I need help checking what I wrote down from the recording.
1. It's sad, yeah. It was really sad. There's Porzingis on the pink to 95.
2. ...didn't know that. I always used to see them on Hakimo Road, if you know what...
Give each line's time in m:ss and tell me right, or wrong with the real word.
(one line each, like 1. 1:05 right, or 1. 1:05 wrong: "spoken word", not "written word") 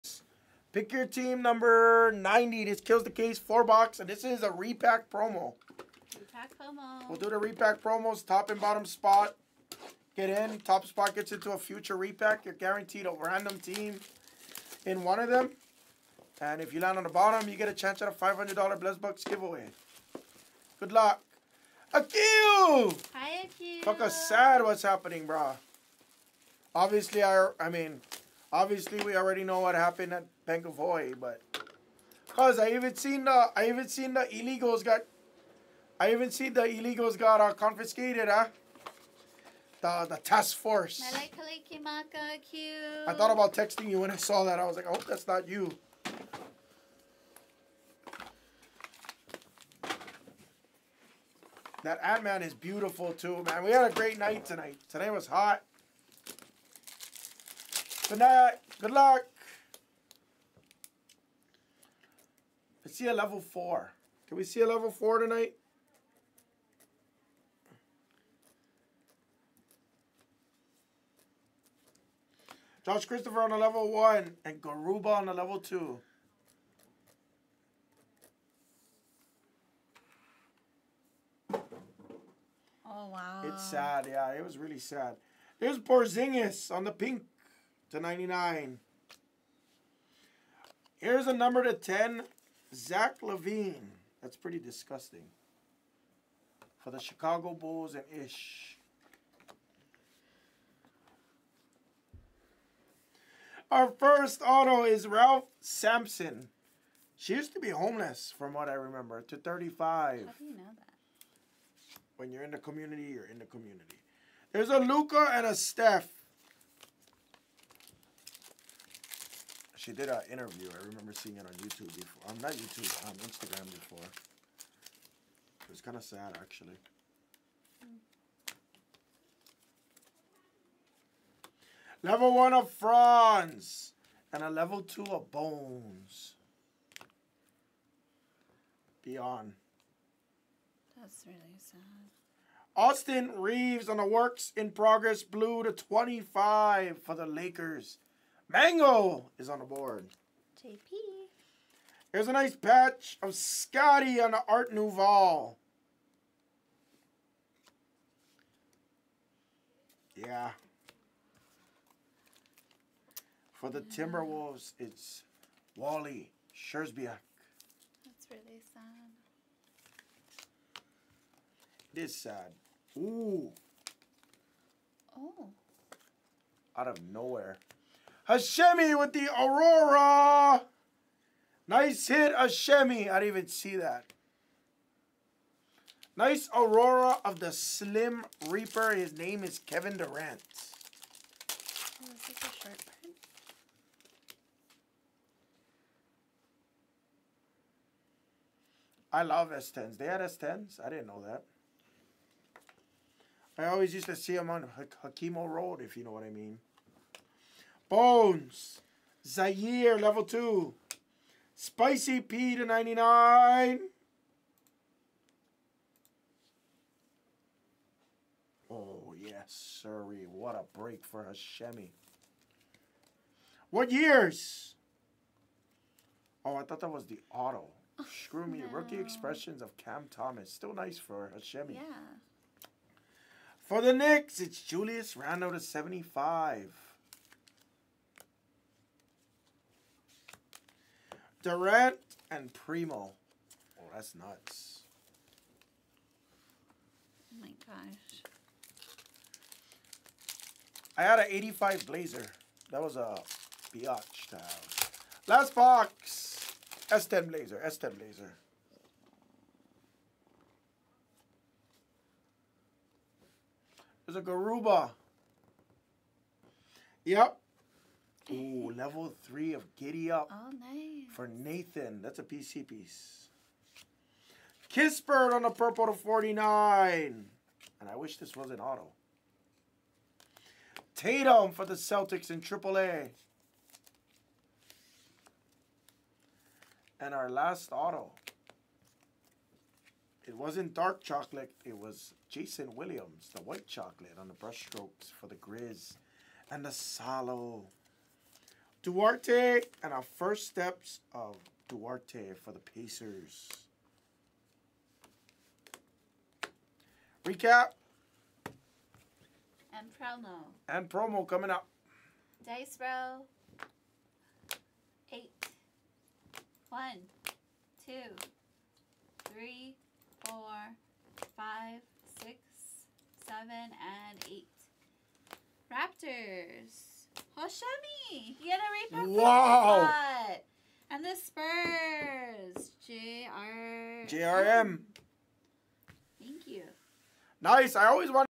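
1. 1:23 wrong: "99", not "95"
2. 3:20 right.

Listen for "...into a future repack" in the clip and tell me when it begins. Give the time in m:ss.
0:11.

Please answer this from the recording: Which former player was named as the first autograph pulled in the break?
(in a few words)
Ralph Sampson.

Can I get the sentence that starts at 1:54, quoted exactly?
There's a Luka and a Steph.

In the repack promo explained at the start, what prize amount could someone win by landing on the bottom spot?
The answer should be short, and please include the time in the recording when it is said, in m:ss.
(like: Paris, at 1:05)
$500, at 0:18.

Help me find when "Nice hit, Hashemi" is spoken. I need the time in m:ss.
3:01.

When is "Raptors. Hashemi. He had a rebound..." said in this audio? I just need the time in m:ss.
5:25.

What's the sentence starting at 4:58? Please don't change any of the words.
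Duarte and our first steps of Duarte for the Pacers.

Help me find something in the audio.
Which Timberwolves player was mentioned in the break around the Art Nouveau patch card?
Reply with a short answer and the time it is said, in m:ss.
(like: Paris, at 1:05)
Wally Szczerbiak, at 2:45.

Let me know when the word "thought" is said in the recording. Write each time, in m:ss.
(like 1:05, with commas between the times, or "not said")
0:43, 3:46.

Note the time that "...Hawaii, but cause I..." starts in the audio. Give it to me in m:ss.
0:30.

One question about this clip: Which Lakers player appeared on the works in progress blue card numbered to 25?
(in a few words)
Austin Reaves.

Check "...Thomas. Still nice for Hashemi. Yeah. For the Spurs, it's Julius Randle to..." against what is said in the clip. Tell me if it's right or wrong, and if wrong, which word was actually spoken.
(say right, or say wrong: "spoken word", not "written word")
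wrong: "Knicks", not "Spurs".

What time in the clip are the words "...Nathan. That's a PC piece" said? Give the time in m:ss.
4:31.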